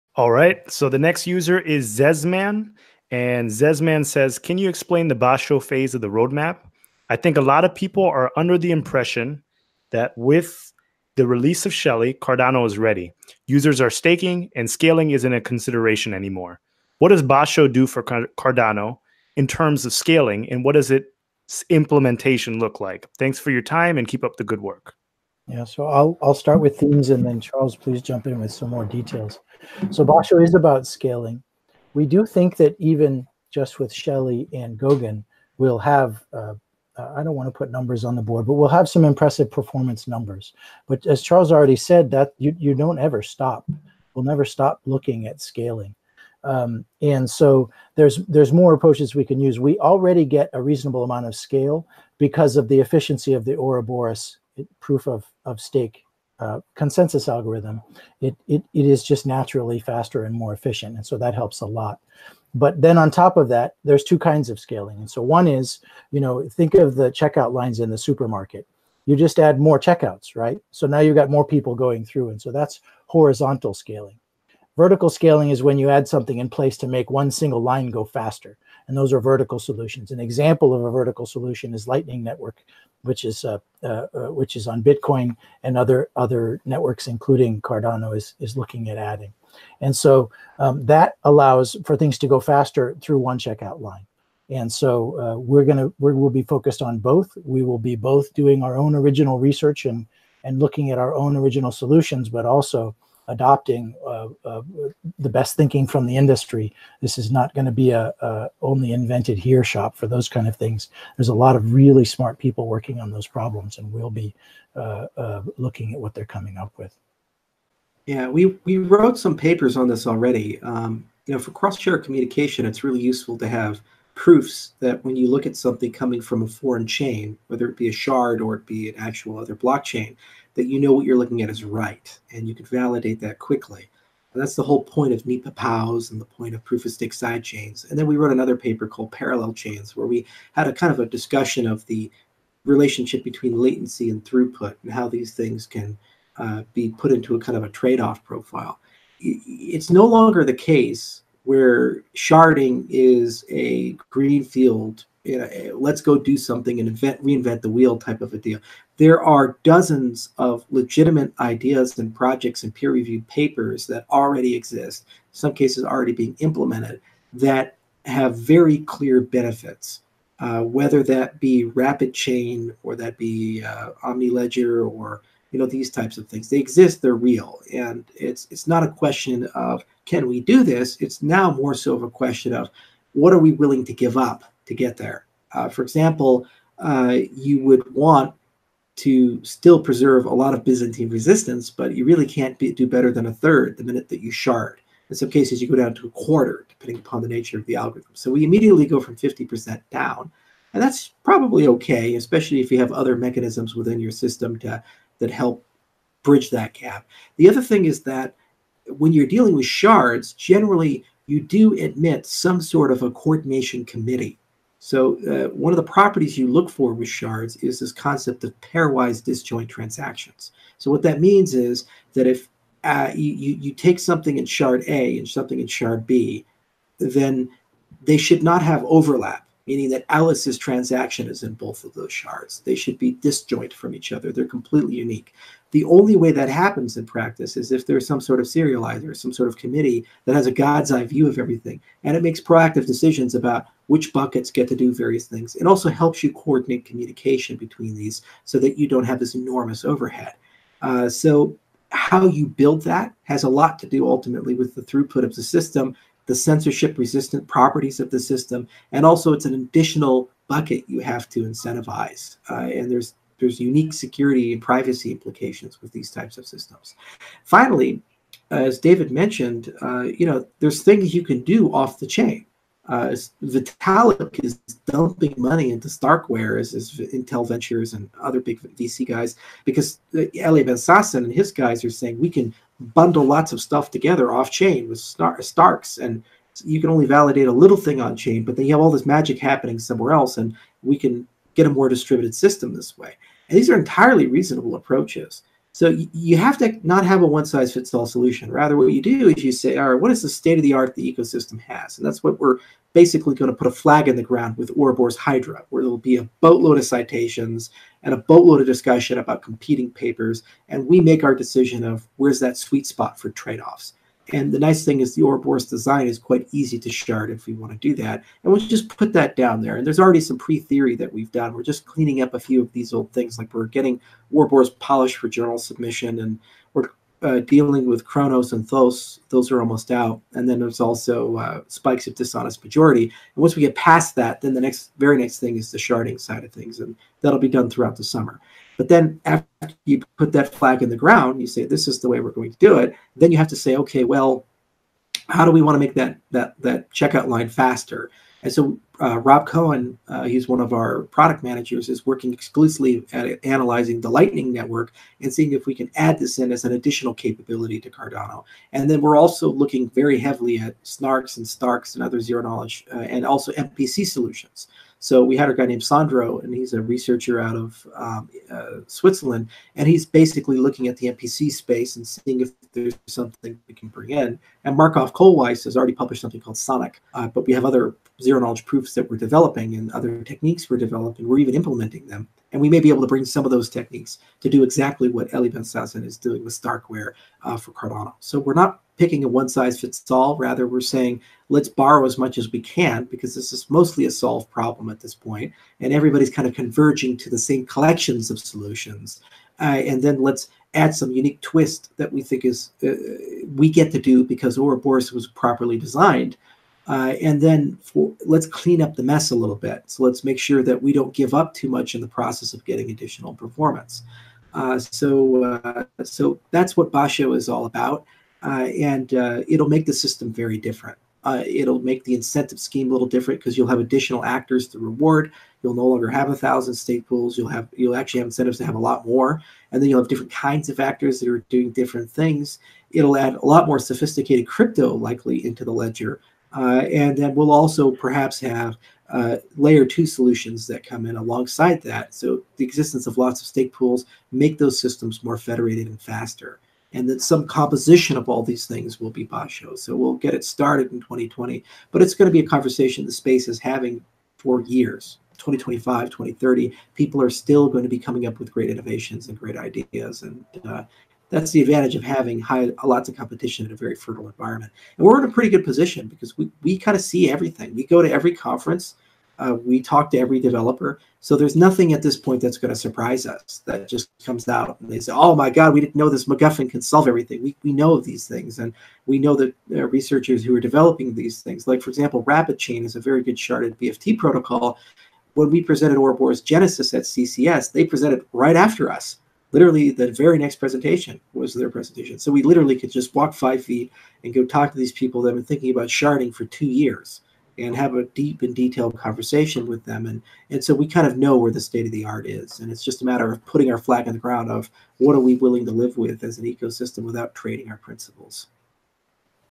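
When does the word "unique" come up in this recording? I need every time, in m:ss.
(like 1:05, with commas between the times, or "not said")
3:54, 4:23, 6:41.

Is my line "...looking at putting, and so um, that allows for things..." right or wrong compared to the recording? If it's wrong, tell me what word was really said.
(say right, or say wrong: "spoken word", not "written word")
wrong: "adding", not "putting".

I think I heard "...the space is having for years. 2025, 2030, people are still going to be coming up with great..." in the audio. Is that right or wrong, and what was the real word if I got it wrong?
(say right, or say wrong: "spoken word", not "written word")
right.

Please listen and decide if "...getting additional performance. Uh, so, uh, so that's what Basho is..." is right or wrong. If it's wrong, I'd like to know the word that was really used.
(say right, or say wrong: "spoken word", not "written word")
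right.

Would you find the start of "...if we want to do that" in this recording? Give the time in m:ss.
5:17.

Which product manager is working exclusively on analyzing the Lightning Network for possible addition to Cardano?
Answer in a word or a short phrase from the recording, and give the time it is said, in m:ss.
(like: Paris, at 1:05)
Rob Cohen, at 5:49.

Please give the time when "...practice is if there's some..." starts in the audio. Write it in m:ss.
3:57.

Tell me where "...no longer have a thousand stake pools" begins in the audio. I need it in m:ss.
7:05.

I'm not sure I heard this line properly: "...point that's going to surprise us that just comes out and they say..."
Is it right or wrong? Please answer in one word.
right.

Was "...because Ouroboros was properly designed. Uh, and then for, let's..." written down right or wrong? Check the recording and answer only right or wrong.
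right.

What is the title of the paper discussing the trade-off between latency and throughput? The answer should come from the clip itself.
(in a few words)
Parallel Chains.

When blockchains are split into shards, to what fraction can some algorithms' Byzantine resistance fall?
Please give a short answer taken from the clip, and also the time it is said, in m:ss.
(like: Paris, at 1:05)
a quarter, at 3:16.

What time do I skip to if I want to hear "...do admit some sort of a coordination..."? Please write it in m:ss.
3:31.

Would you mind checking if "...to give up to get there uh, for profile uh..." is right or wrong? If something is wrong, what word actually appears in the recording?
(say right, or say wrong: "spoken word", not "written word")
wrong: "example", not "profile".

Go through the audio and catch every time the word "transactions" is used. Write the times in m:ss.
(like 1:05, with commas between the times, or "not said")
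3:39, 3:50.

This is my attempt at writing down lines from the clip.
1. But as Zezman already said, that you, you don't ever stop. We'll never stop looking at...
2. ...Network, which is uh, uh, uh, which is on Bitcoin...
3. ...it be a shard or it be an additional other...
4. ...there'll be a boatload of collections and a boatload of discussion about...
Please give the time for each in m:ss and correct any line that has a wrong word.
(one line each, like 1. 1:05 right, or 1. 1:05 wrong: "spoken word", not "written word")
1. 0:40 wrong: "Charles", not "Zezman"
2. 1:22 right
3. 2:07 wrong: "actual", not "additional"
4. 5:05 wrong: "citations", not "collections".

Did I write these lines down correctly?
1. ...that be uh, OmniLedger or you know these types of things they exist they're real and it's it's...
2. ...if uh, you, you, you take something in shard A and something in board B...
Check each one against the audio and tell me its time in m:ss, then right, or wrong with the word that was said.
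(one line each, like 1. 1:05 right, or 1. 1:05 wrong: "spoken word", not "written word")
1. 2:52 right
2. 3:42 wrong: "shard", not "board".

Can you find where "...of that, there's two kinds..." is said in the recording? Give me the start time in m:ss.
1:03.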